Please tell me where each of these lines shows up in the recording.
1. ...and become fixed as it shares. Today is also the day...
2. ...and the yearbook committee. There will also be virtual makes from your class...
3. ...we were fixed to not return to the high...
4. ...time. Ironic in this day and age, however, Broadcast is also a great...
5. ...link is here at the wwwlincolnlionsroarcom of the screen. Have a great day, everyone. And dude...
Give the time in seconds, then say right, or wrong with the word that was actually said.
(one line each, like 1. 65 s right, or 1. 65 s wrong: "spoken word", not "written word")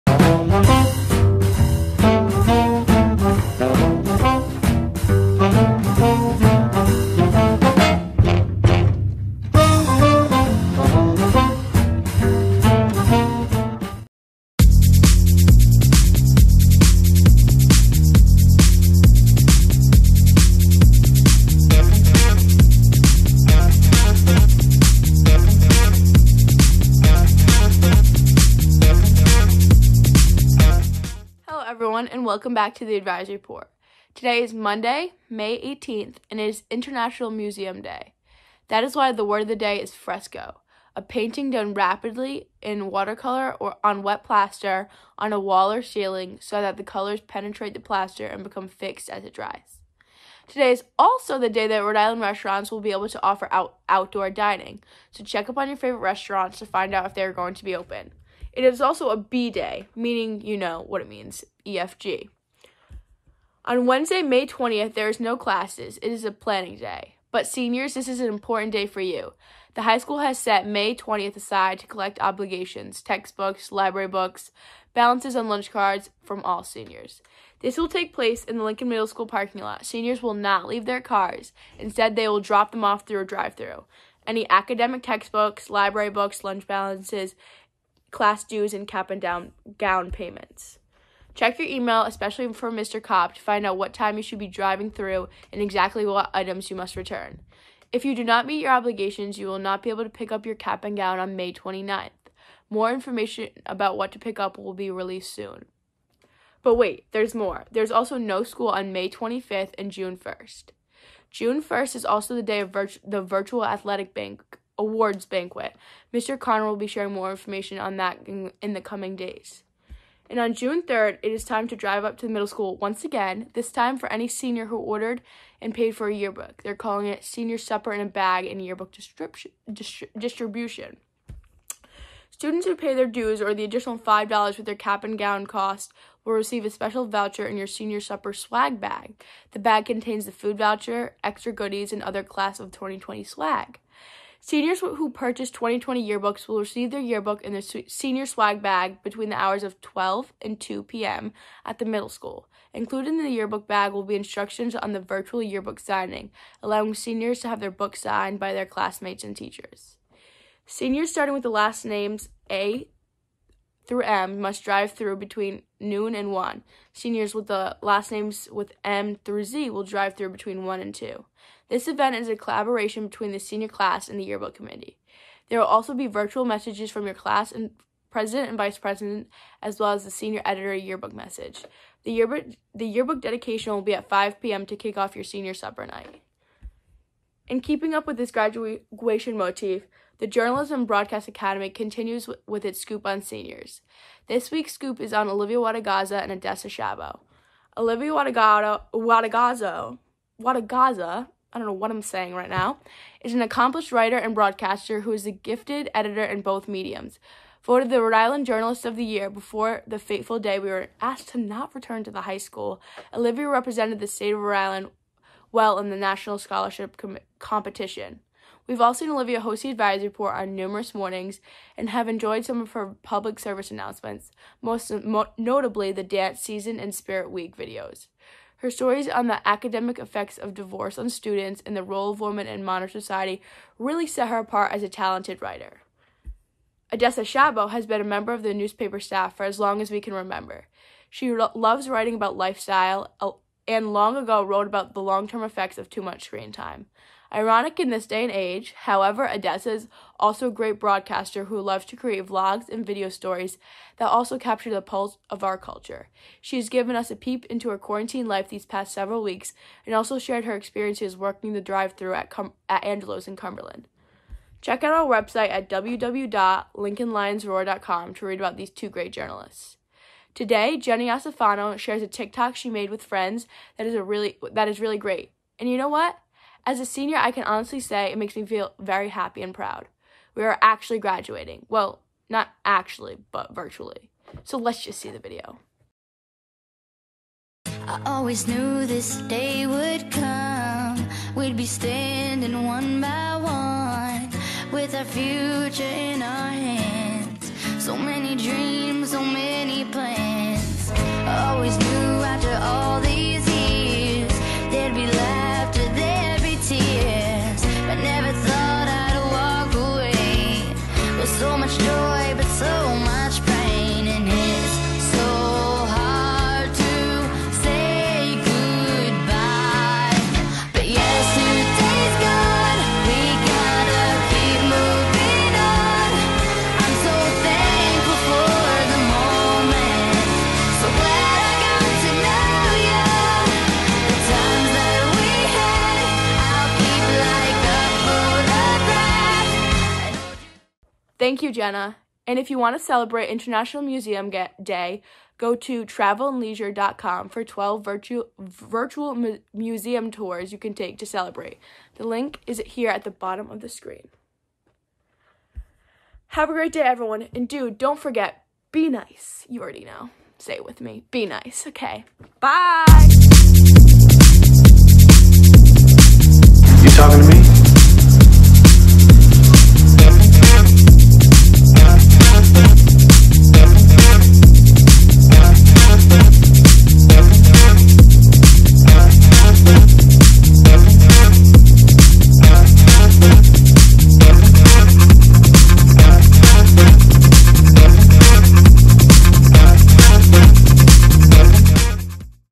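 1. 48 s wrong: "dries", not "shares"
2. 174 s wrong: "messages", not "makes"
3. 210 s wrong: "asked", not "fixed"
4. 246 s wrong: "Odessa", not "Broadcast"
5. 352 s wrong: "bottom", not "wwwlincolnlionsroarcom".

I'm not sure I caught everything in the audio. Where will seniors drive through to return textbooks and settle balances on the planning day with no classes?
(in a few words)
Lincoln Middle School parking lot.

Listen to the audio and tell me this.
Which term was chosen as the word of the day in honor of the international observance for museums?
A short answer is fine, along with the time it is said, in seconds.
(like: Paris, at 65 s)
fresco, at 39 s.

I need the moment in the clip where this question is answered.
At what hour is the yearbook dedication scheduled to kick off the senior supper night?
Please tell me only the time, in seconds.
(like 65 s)
184 s.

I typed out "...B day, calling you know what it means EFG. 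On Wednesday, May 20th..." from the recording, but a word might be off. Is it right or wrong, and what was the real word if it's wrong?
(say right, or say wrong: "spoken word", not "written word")
wrong: "meaning", not "calling".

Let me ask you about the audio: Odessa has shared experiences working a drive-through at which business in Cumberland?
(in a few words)
Angelo's.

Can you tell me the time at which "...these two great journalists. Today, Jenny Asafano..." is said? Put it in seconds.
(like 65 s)
268 s.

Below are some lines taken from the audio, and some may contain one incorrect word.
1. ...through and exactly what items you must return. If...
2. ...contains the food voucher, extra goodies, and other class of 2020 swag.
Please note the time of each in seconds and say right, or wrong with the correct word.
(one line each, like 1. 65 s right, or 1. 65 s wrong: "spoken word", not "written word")
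1. 94 s right
2. 139 s right.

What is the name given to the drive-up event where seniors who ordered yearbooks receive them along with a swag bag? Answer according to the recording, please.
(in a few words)
Senior Supper in a Bag.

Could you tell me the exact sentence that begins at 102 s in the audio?
More information about what to pick up will be released soon.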